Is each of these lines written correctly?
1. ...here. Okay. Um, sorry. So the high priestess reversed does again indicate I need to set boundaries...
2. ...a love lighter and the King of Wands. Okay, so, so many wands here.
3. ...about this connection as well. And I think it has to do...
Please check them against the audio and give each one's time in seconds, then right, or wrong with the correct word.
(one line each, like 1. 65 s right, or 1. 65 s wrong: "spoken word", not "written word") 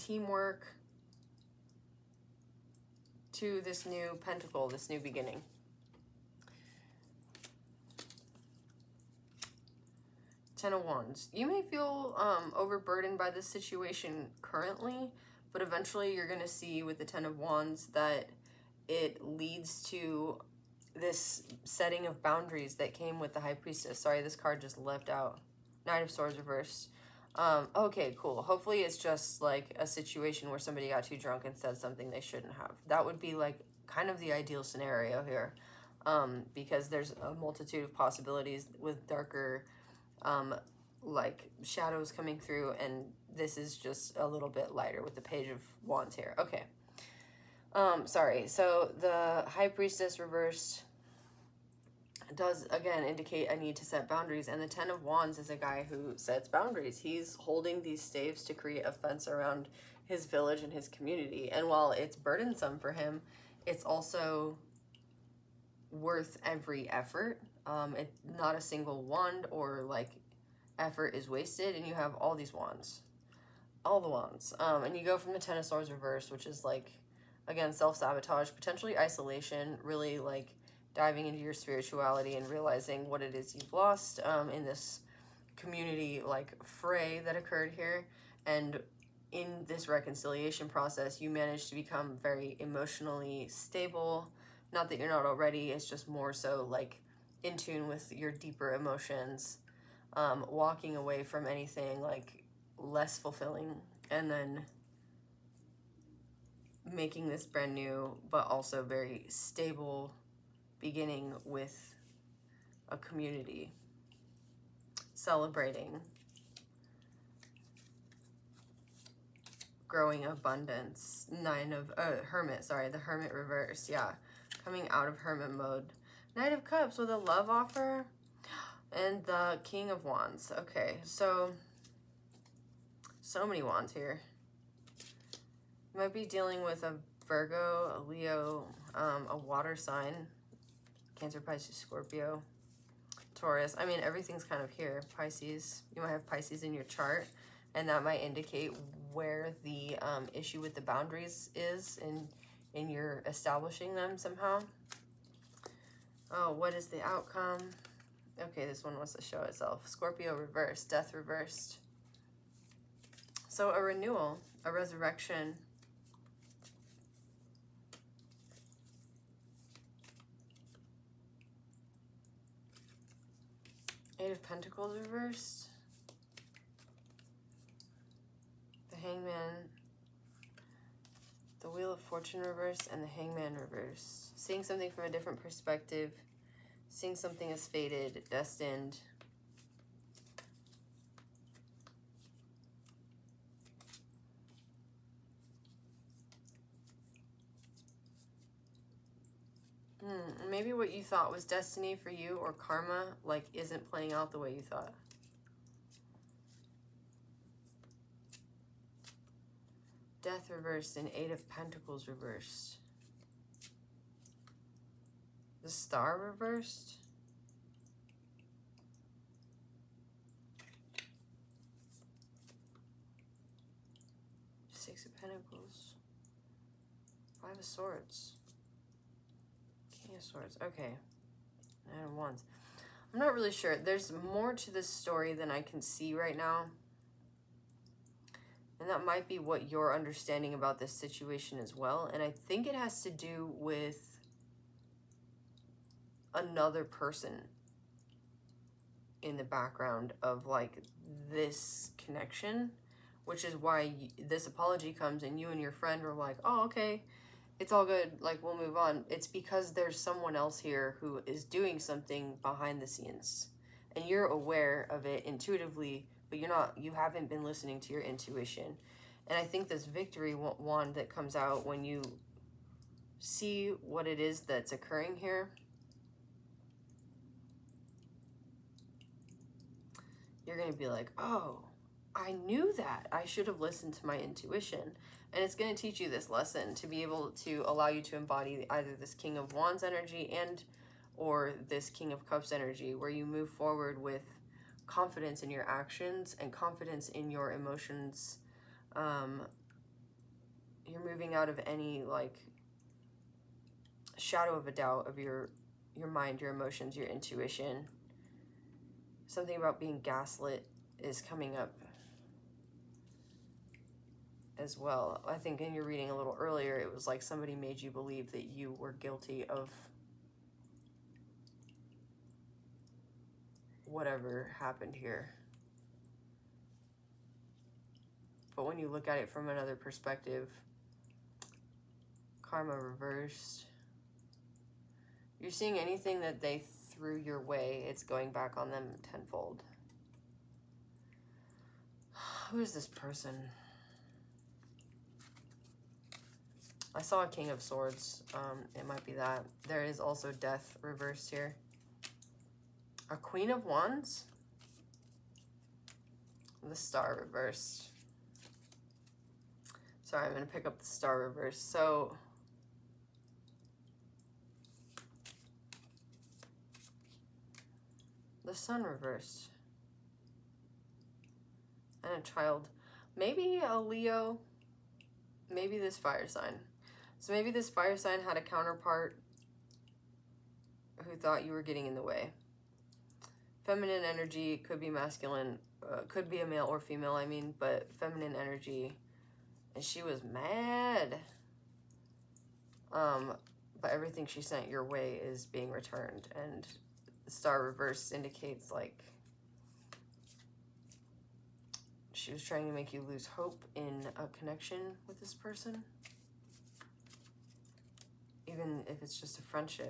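1. 46 s right
2. 127 s wrong: "offer", not "lighter"
3. 240 s wrong: "situation", not "connection".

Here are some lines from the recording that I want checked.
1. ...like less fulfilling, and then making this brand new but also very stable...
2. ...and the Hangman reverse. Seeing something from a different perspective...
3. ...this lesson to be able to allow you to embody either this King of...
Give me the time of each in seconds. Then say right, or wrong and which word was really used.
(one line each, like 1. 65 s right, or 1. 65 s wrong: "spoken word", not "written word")
1. 102 s right
2. 182 s right
3. 286 s right.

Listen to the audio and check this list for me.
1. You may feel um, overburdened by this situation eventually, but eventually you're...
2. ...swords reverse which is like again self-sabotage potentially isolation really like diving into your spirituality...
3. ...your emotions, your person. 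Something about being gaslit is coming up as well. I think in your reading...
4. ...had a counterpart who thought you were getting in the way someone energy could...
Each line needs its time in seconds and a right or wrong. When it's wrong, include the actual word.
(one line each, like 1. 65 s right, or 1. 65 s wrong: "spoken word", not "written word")
1. 11 s wrong: "currently", not "eventually"
2. 75 s right
3. 306 s wrong: "intuition", not "person"
4. 378 s wrong: "feminine", not "someone".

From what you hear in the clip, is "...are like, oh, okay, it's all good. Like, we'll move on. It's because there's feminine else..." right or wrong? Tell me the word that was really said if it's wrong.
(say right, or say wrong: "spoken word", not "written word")
wrong: "someone", not "feminine".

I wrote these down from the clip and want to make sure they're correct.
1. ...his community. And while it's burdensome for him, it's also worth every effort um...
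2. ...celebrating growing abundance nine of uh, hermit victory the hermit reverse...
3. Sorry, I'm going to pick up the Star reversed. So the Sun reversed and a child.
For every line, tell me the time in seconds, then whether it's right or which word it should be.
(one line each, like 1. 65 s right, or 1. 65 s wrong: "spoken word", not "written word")
1. 60 s right
2. 115 s wrong: "sorry", not "victory"
3. 360 s right.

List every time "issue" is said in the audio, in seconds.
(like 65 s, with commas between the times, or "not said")
150 s.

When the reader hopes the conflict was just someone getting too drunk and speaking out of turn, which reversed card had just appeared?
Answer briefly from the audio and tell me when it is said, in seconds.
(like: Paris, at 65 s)
Knight of Swords, at 25 s.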